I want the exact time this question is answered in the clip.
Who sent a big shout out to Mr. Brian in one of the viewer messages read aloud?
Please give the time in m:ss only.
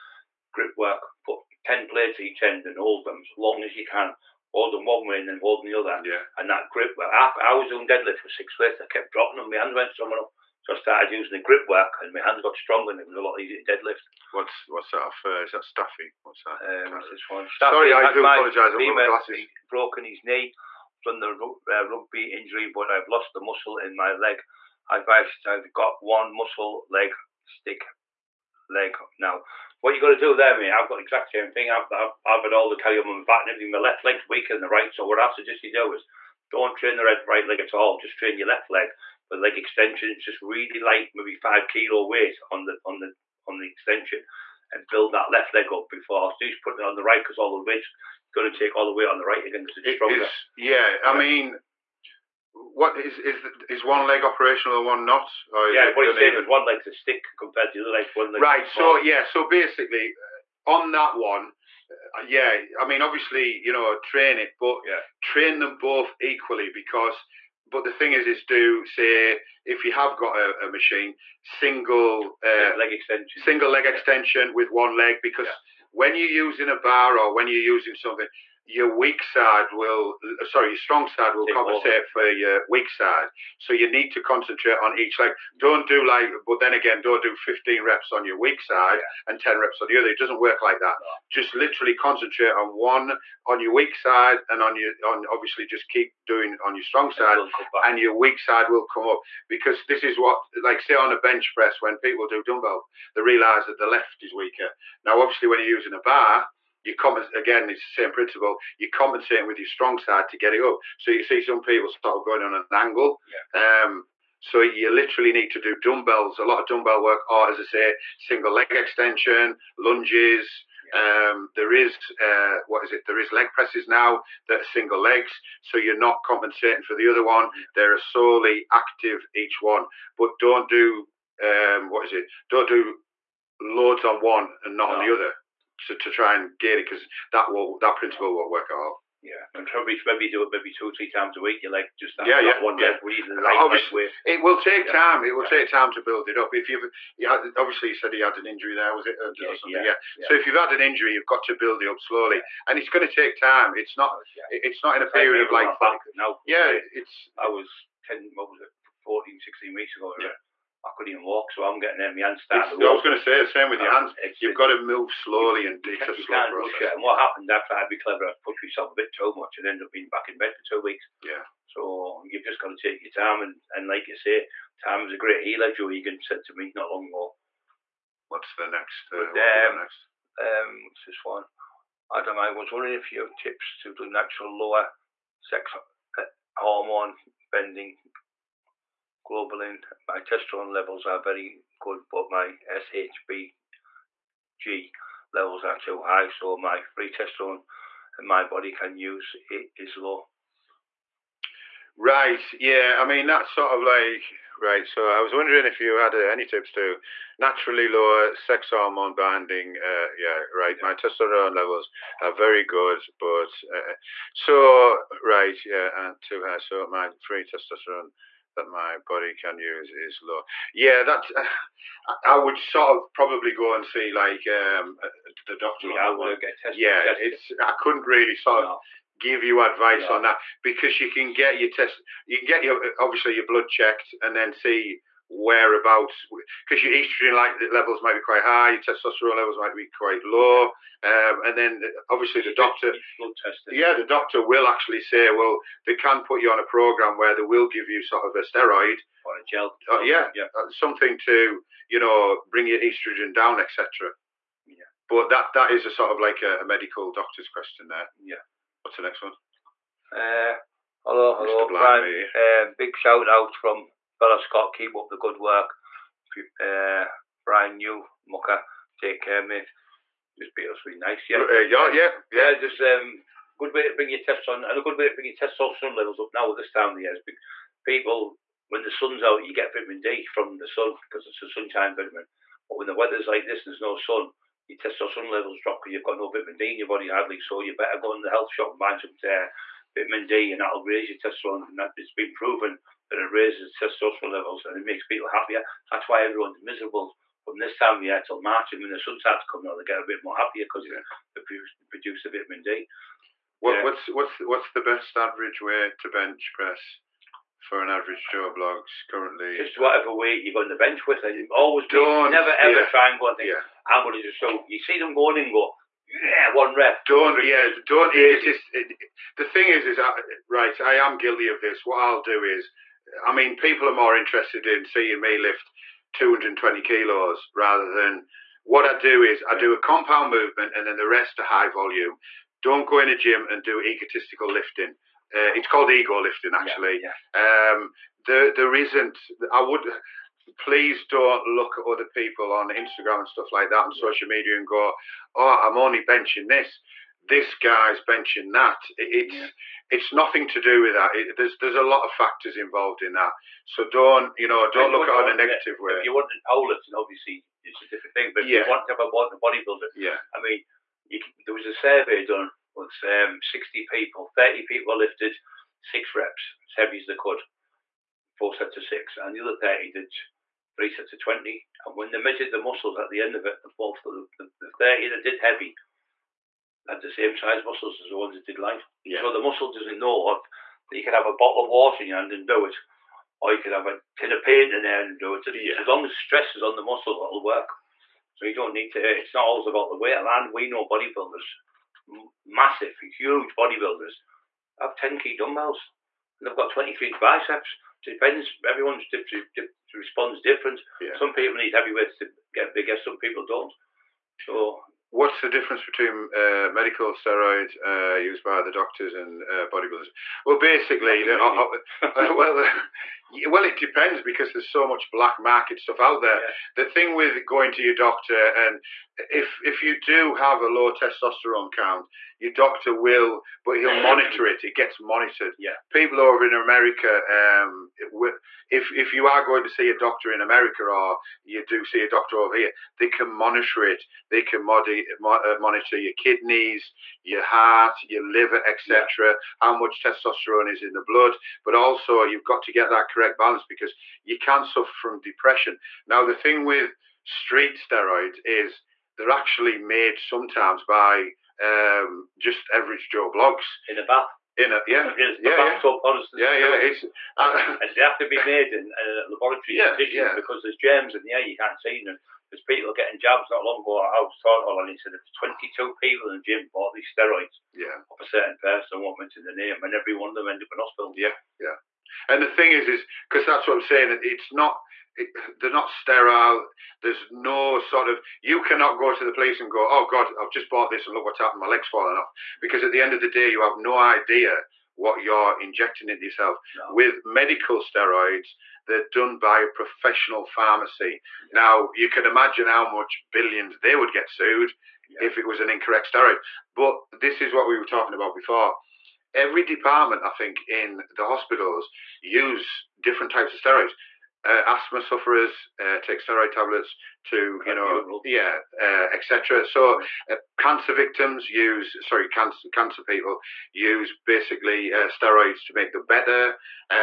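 4:24.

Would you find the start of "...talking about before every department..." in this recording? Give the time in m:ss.
8:17.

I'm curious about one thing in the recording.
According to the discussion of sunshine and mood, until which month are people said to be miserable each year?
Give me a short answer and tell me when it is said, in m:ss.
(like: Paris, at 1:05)
March, at 4:58.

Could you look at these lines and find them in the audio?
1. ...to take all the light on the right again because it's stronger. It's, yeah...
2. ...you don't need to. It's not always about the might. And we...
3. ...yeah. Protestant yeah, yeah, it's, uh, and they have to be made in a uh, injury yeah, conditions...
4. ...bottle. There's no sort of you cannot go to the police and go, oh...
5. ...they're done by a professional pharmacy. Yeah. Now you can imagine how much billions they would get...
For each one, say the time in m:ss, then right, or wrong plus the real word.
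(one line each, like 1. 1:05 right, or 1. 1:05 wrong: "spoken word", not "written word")
1. 0:48 wrong: "weight", not "light"
2. 6:28 wrong: "weight", not "might"
3. 7:35 wrong: "laboratory", not "injury"
4. 7:55 wrong: "sterile", not "bottle"
5. 8:08 right.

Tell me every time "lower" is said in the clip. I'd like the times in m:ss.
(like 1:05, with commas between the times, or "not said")
3:04, 3:27.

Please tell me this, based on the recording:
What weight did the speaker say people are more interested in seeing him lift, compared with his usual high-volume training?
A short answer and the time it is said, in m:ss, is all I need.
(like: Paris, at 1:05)
220 kilos, at 5:26.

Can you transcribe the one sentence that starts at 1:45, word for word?
Now, obviously when you're using a bar, you again.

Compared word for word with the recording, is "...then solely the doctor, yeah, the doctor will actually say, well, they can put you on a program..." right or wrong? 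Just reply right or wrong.
wrong.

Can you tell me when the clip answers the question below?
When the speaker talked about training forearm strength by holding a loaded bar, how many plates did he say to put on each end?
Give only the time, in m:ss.
0:01.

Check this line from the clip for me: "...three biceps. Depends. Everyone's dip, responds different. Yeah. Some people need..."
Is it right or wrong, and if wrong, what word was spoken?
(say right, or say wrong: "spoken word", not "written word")
right.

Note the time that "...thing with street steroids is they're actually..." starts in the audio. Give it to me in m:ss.
7:26.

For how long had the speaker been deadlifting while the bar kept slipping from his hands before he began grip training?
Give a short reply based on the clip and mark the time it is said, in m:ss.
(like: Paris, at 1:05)
6 weeks, at 0:08.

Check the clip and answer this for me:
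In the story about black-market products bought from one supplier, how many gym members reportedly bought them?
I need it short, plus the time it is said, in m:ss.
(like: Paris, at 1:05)
22, at 7:45.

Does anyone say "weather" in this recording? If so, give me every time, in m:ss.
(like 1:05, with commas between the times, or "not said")
4:42.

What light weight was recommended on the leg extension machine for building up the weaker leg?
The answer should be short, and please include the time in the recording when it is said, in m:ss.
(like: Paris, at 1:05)
5 kilos, at 0:41.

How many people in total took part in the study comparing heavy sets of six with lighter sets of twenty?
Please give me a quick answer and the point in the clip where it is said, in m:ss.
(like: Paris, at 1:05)
60, at 6:03.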